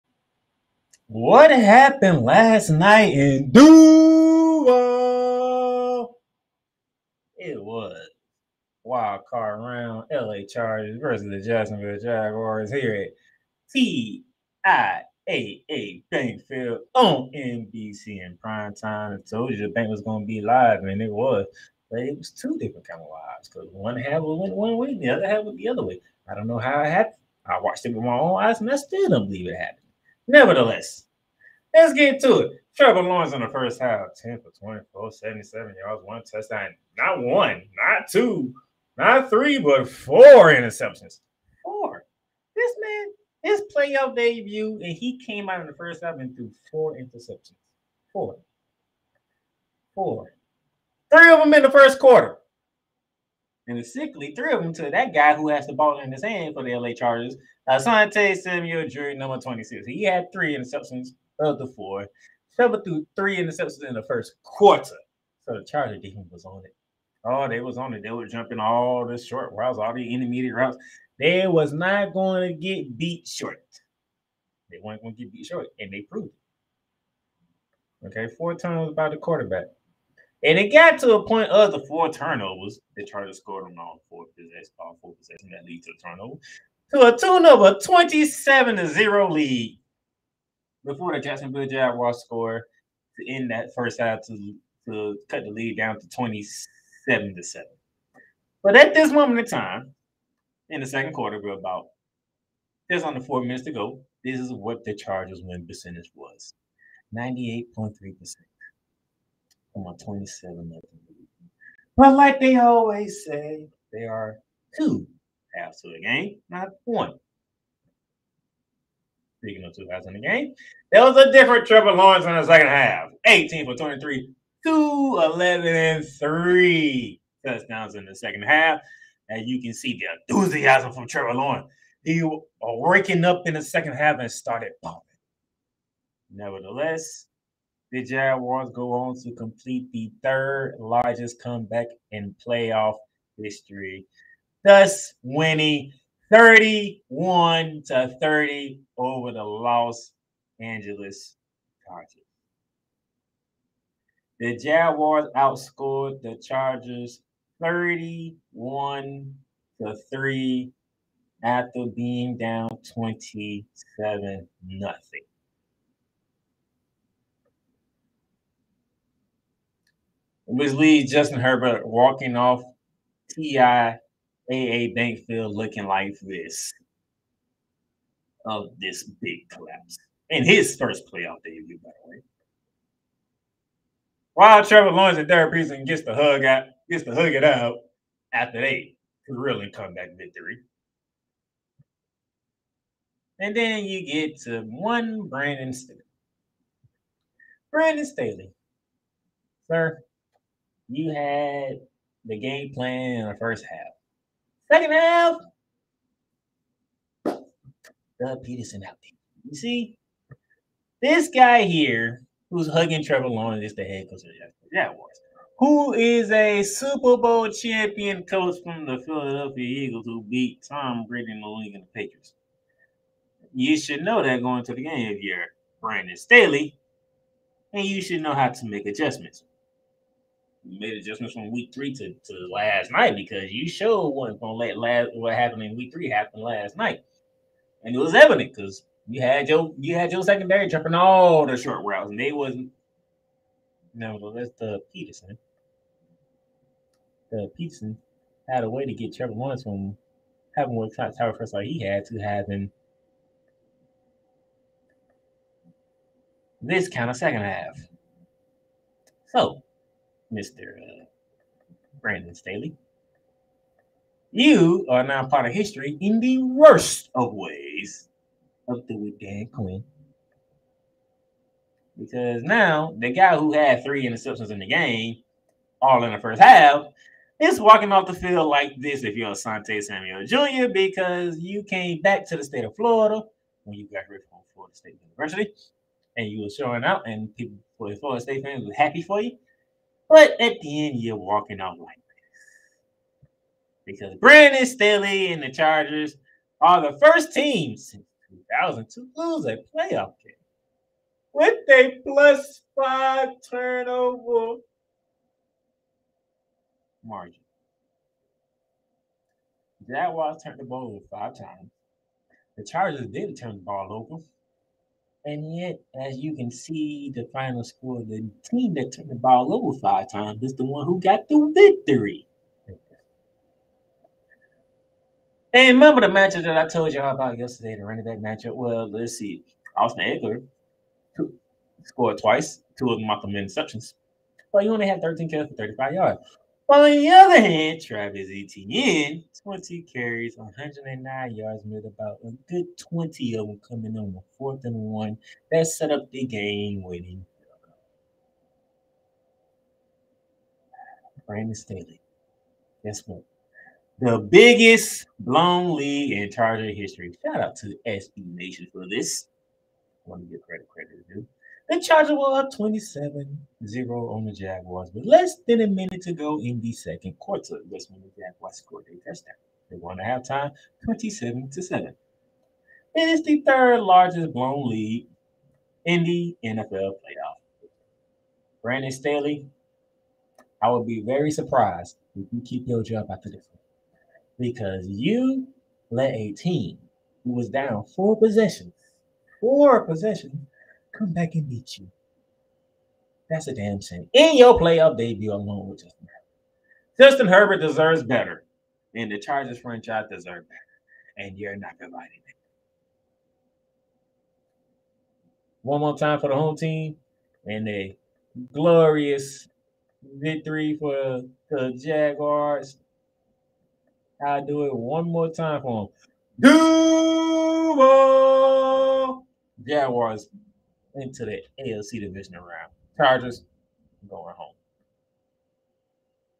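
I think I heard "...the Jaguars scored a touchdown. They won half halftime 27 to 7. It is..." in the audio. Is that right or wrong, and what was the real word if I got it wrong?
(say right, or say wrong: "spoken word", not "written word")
right.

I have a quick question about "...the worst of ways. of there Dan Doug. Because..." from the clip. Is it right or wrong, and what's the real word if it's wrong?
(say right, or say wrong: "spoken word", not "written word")
wrong: "Quinn", not "Doug".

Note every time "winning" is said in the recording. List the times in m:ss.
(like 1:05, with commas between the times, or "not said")
2:25, 5:46.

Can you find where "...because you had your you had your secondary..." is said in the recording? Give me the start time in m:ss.
3:58.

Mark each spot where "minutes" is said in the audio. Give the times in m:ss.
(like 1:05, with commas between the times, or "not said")
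1:43, 6:05.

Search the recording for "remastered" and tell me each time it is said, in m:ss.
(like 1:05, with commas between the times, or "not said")
not said.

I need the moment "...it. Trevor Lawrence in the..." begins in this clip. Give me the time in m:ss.
0:32.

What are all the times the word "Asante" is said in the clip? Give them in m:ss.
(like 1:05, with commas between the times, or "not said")
0:57, 4:39.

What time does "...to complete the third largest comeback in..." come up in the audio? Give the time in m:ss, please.
2:19.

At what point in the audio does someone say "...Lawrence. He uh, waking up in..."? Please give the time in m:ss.
2:11.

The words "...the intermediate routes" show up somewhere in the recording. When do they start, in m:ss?
1:09.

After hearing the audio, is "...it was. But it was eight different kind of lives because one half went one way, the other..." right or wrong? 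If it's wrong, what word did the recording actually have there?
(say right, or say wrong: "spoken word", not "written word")
wrong: "two", not "eight".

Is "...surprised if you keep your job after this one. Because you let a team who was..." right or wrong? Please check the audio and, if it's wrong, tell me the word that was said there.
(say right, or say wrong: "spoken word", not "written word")
right.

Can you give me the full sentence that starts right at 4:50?
But at the end, you're walking out like this.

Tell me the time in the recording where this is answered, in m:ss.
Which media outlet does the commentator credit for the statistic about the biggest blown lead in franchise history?
5:57.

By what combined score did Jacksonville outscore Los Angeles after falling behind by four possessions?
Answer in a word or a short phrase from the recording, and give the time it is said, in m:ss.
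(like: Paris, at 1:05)
31 to 3, at 2:37.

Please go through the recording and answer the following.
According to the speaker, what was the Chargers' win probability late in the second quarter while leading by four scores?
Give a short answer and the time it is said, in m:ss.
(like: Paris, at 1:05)
98.3%, at 1:47.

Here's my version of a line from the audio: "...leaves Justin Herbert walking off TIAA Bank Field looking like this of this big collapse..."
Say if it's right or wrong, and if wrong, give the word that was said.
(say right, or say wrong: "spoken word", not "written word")
right.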